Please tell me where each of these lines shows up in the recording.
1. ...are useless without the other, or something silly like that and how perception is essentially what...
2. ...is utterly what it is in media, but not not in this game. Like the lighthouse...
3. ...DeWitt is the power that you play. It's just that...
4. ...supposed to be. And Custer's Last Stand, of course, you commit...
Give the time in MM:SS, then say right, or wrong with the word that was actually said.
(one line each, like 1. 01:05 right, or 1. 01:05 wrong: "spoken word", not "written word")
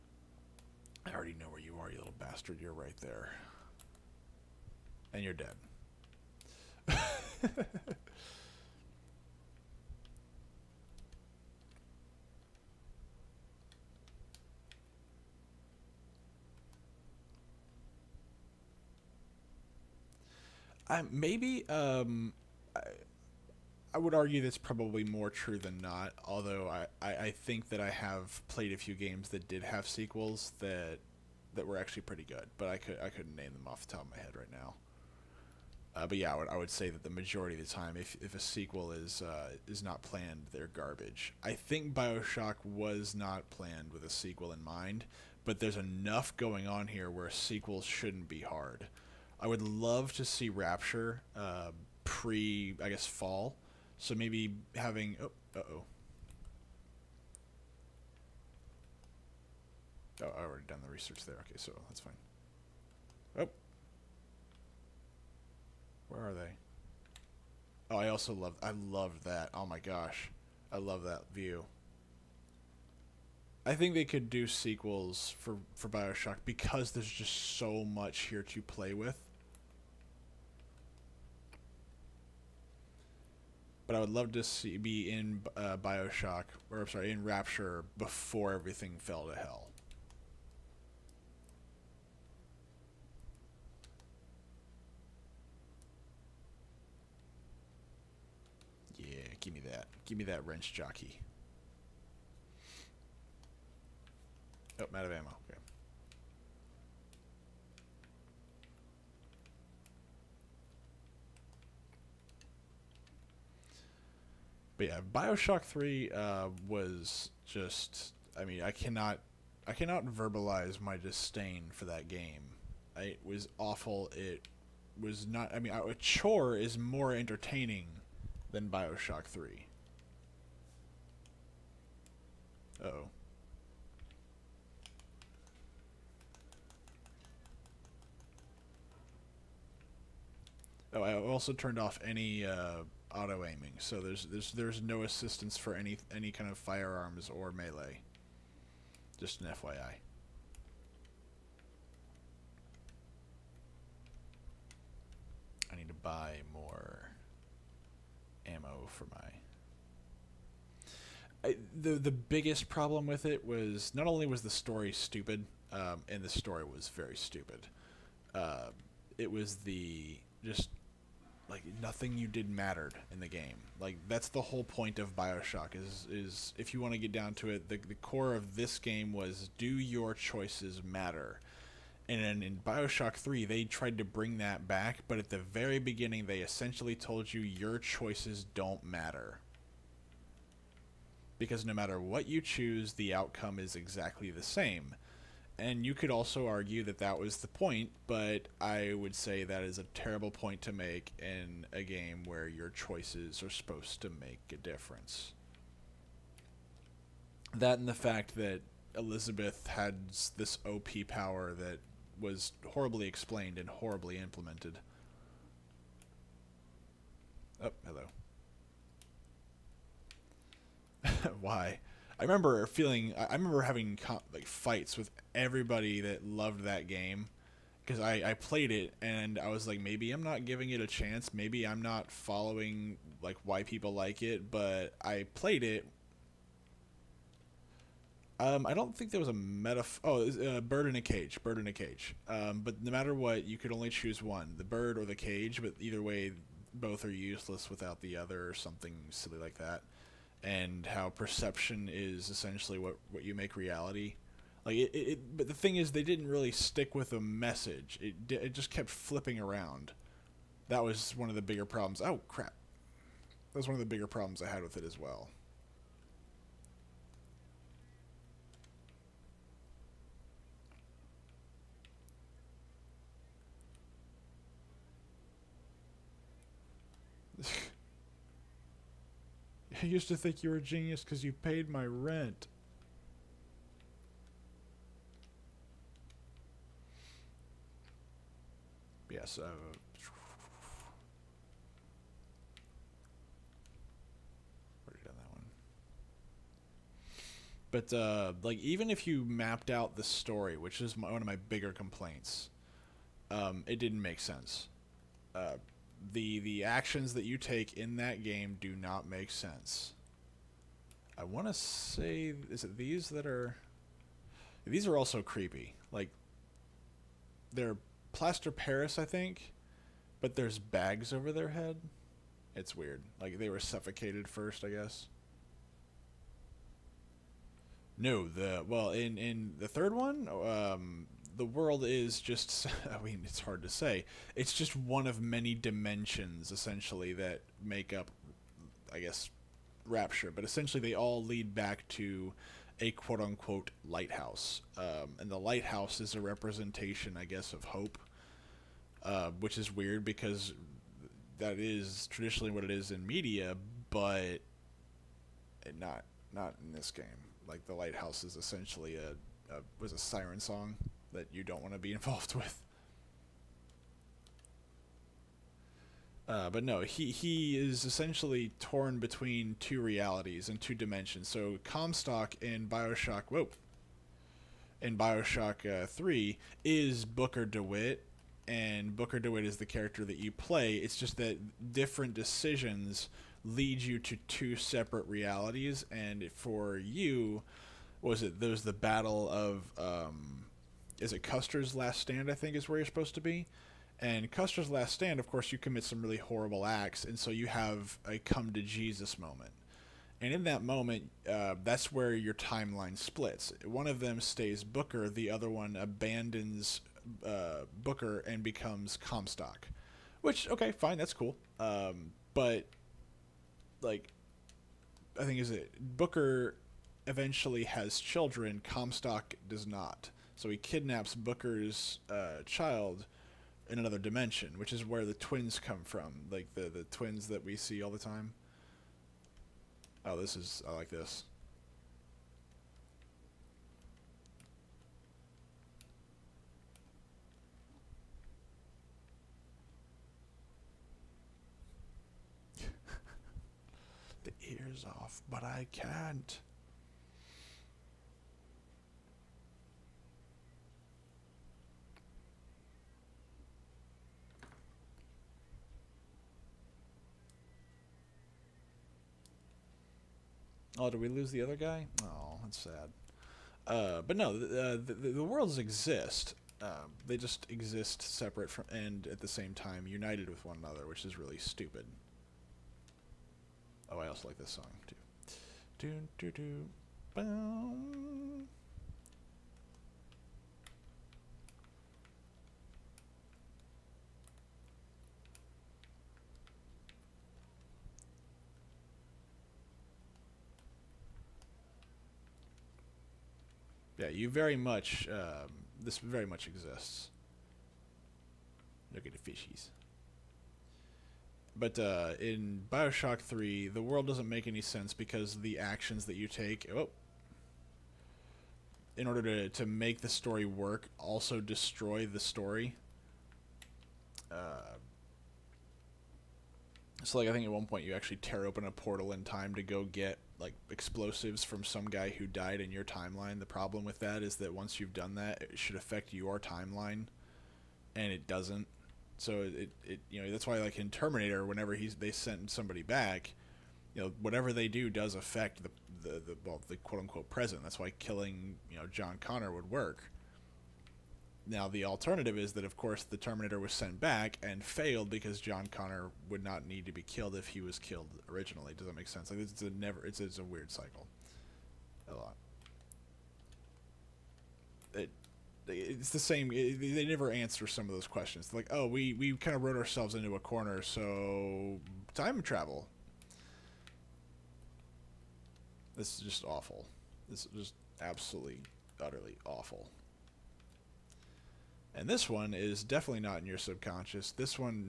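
1. 04:07 right
2. 05:51 wrong: "traditionally", not "utterly"
3. 06:19 wrong: "character", not "power"
4. 06:32 right.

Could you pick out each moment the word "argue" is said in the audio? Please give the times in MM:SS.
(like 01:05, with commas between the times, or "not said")
00:24, 03:16.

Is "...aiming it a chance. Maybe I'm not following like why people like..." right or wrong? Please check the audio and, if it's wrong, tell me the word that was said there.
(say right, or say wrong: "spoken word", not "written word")
wrong: "giving", not "aiming".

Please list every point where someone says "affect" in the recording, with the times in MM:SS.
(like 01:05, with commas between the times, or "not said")
08:45, 08:55.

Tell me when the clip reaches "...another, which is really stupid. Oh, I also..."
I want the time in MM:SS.
07:50.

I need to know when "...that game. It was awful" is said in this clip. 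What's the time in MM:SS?
02:01.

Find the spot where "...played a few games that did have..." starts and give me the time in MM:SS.
00:28.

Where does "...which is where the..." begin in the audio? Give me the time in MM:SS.
07:04.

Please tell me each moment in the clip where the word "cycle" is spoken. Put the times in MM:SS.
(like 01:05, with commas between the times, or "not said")
09:10.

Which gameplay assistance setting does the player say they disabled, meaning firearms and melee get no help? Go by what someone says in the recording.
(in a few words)
auto aiming.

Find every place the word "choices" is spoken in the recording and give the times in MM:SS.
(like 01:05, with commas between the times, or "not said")
03:00, 03:07, 03:22.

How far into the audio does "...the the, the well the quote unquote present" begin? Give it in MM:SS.
08:55.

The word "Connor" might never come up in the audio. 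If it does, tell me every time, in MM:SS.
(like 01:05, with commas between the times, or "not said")
08:59, 09:05.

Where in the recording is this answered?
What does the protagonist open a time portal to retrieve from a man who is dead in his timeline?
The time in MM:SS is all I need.
08:40.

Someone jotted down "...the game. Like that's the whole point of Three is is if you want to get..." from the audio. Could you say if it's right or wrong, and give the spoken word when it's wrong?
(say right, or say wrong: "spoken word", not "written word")
wrong: "BioShock", not "Three".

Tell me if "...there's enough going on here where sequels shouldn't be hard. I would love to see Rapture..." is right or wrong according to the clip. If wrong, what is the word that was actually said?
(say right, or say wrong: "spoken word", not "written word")
right.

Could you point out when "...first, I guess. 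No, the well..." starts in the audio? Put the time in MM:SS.
05:24.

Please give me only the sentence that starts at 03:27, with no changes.
That and the fact that Elizabeth had this OP power that was horribly explained and horribly implemented.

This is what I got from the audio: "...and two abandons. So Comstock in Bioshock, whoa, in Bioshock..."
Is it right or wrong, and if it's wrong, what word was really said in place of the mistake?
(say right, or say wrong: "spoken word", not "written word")
wrong: "dimensions", not "abandons".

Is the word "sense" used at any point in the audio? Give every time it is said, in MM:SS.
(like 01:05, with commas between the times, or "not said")
05:04, 05:09, 08:24, 09:09.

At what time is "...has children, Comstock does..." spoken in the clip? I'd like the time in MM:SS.
06:57.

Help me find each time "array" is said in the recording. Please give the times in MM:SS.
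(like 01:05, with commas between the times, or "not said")
not said.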